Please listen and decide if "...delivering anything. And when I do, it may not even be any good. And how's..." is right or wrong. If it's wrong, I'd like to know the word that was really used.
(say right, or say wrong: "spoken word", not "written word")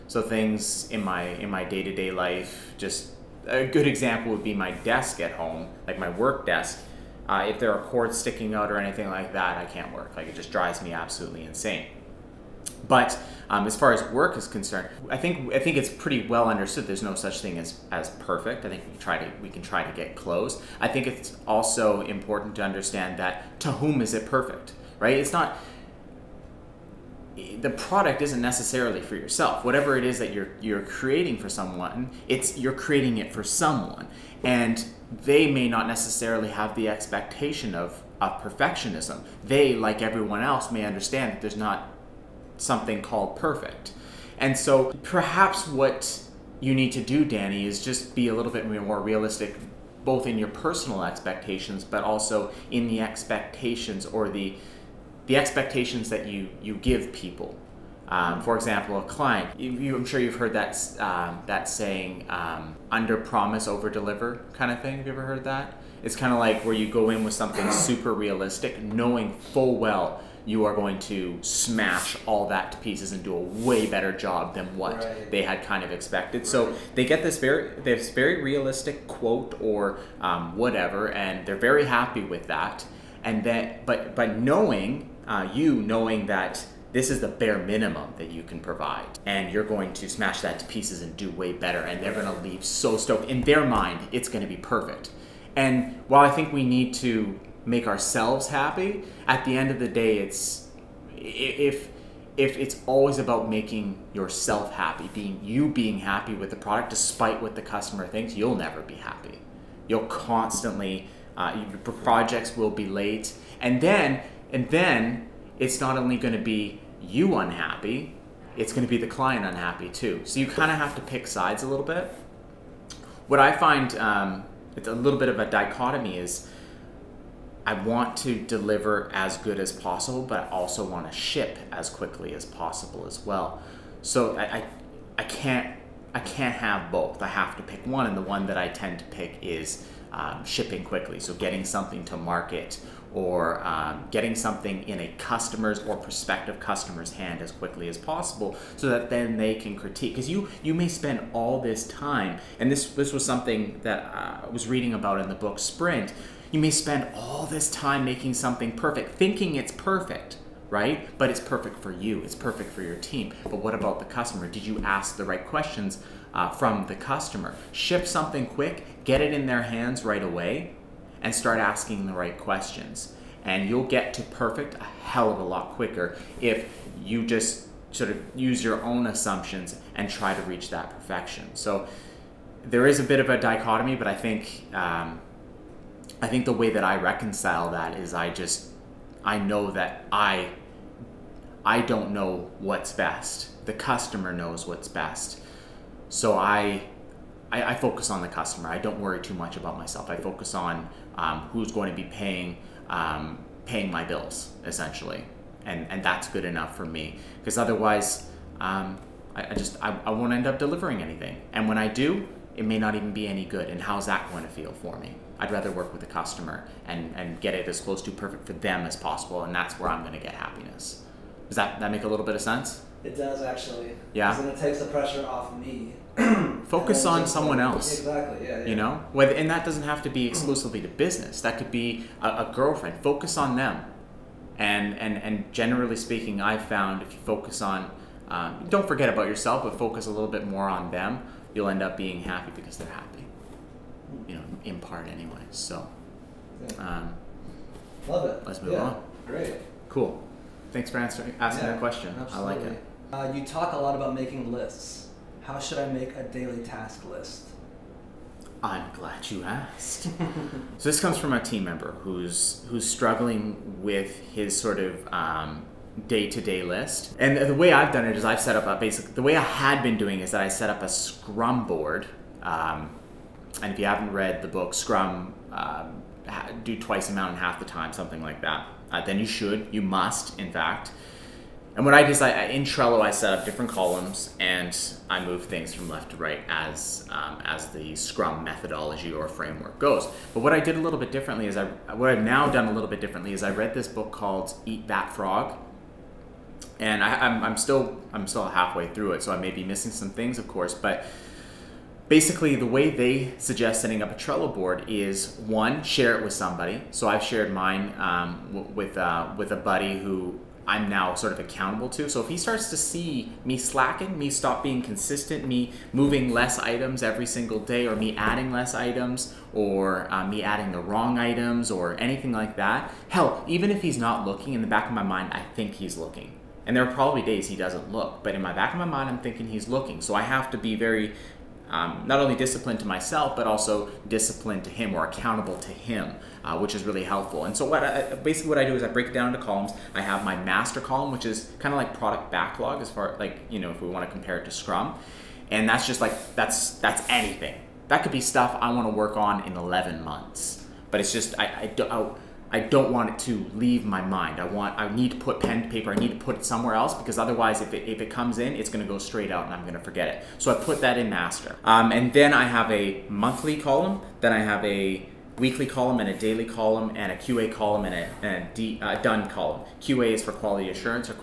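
right.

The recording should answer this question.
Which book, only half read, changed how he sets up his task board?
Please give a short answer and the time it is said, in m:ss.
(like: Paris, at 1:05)
Eat That Frog, at 4:54.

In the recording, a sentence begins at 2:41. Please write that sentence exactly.
But it's perfect for you, it's perfect for your team.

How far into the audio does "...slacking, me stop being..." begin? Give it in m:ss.
5:13.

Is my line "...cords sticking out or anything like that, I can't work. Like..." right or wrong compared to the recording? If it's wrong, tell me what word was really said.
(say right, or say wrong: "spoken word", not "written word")
right.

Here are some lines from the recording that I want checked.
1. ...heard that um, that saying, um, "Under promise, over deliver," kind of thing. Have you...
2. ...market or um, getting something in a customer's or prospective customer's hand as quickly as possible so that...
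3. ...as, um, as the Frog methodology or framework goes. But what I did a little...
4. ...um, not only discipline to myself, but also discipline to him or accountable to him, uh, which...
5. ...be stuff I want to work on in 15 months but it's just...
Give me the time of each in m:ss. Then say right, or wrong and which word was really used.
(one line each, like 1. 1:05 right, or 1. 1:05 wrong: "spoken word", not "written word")
1. 1:00 right
2. 2:22 right
3. 4:46 wrong: "Scrum", not "Frog"
4. 5:31 right
5. 5:48 wrong: "11", not "15".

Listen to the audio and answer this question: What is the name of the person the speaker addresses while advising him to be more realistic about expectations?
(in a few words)
Danny.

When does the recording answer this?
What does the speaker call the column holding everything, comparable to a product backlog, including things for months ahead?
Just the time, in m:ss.
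5:40.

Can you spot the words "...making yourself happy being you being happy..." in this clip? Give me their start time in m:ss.
1:43.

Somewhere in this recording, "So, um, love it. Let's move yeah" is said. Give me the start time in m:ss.
4:05.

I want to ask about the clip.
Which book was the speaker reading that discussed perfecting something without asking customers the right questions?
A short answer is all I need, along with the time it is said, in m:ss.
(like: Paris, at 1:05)
Sprint, at 2:35.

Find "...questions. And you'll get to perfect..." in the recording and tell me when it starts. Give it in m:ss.
2:52.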